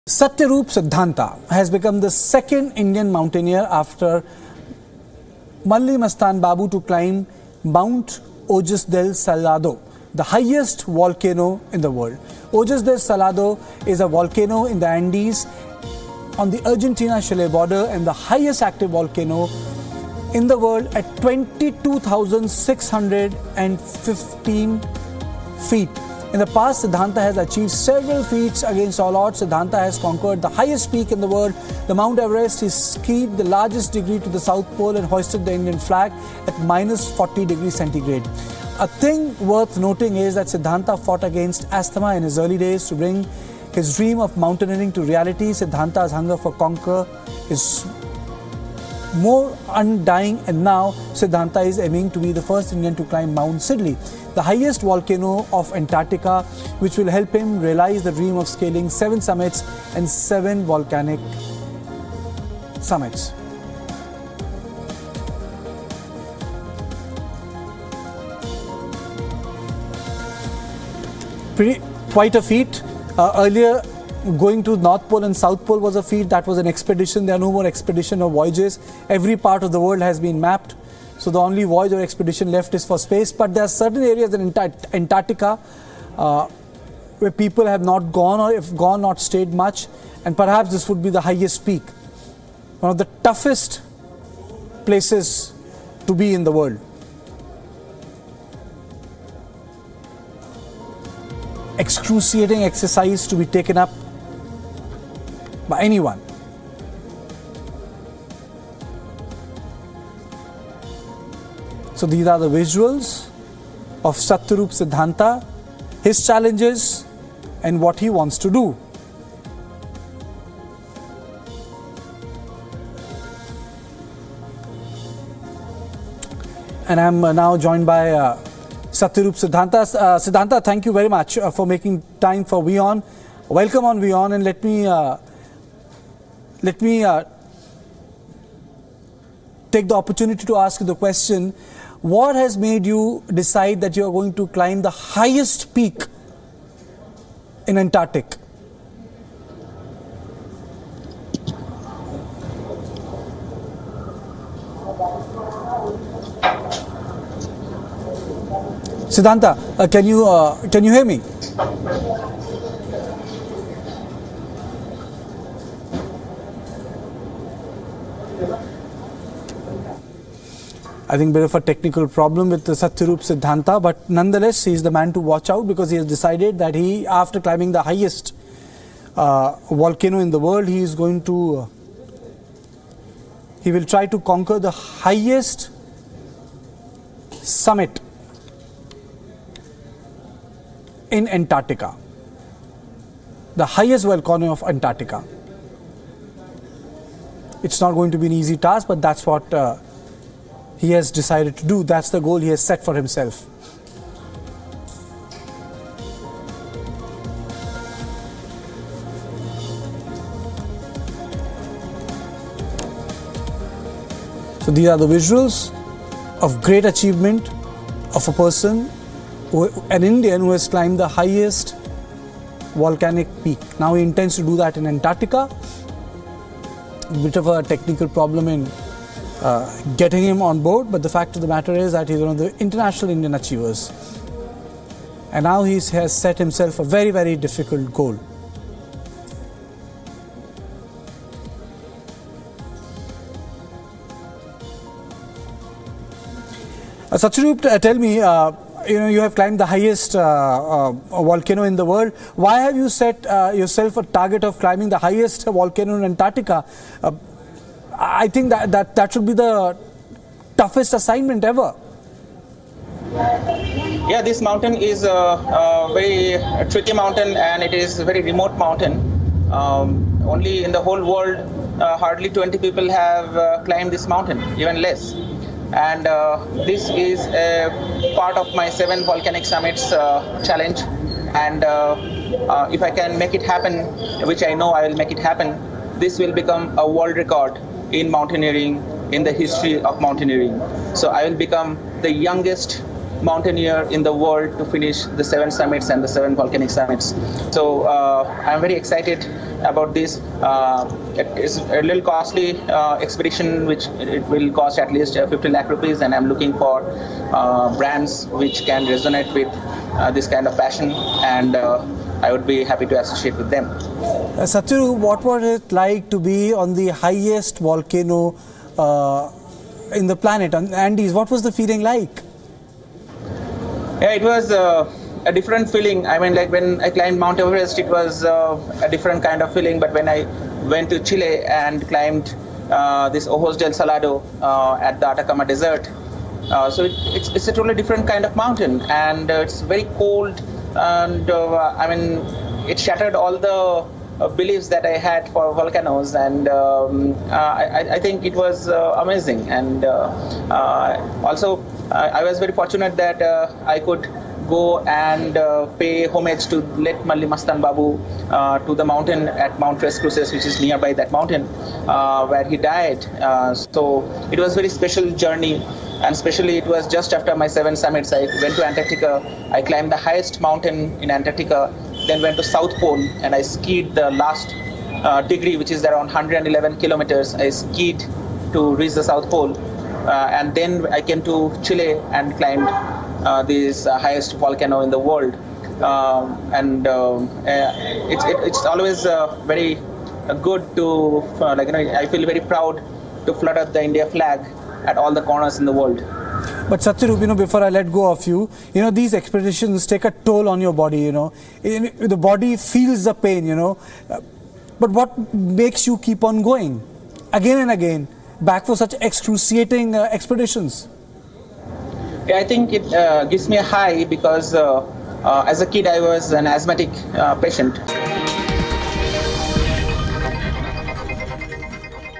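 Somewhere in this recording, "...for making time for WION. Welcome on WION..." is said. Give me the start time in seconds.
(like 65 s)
131 s.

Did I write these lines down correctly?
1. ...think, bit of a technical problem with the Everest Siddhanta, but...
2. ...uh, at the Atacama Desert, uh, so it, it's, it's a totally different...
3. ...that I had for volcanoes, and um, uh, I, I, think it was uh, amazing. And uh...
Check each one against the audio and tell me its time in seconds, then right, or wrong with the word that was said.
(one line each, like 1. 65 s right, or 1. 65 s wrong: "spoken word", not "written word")
1. 171 s wrong: "Satyarup", not "Everest"
2. 334 s right
3. 344 s right.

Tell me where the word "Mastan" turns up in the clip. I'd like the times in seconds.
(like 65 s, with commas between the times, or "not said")
6 s, 357 s.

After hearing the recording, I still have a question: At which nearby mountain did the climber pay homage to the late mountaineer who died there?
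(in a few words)
Mount Tres Cruces.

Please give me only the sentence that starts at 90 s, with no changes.
And perhaps this would be the highest peak.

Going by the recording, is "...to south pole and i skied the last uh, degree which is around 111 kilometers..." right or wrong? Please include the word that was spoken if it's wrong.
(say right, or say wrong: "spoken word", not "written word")
right.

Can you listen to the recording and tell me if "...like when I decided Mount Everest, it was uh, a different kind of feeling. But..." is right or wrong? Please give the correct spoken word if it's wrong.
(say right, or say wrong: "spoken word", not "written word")
wrong: "climbed", not "decided".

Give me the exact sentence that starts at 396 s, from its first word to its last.
But Satyarup, you know, before I let go of you, you know, these expeditions take a toll on your body, you know.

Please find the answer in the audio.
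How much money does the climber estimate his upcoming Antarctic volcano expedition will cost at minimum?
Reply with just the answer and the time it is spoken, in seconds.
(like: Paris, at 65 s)
50 lakh rupees, at 305 s.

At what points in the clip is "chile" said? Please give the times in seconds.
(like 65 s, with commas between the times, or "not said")
17 s, 330 s, 381 s.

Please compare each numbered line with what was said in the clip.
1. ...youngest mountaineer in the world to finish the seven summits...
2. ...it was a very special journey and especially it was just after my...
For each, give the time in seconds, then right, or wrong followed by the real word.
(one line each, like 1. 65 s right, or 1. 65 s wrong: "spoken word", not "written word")
1. 292 s right
2. 364 s right.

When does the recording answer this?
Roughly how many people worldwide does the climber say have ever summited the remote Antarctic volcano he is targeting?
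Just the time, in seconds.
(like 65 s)
272 s.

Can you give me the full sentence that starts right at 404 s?
But what makes you keep on going again and again back for such excruciating uh, expeditions?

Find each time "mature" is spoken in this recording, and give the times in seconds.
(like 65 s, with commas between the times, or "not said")
not said.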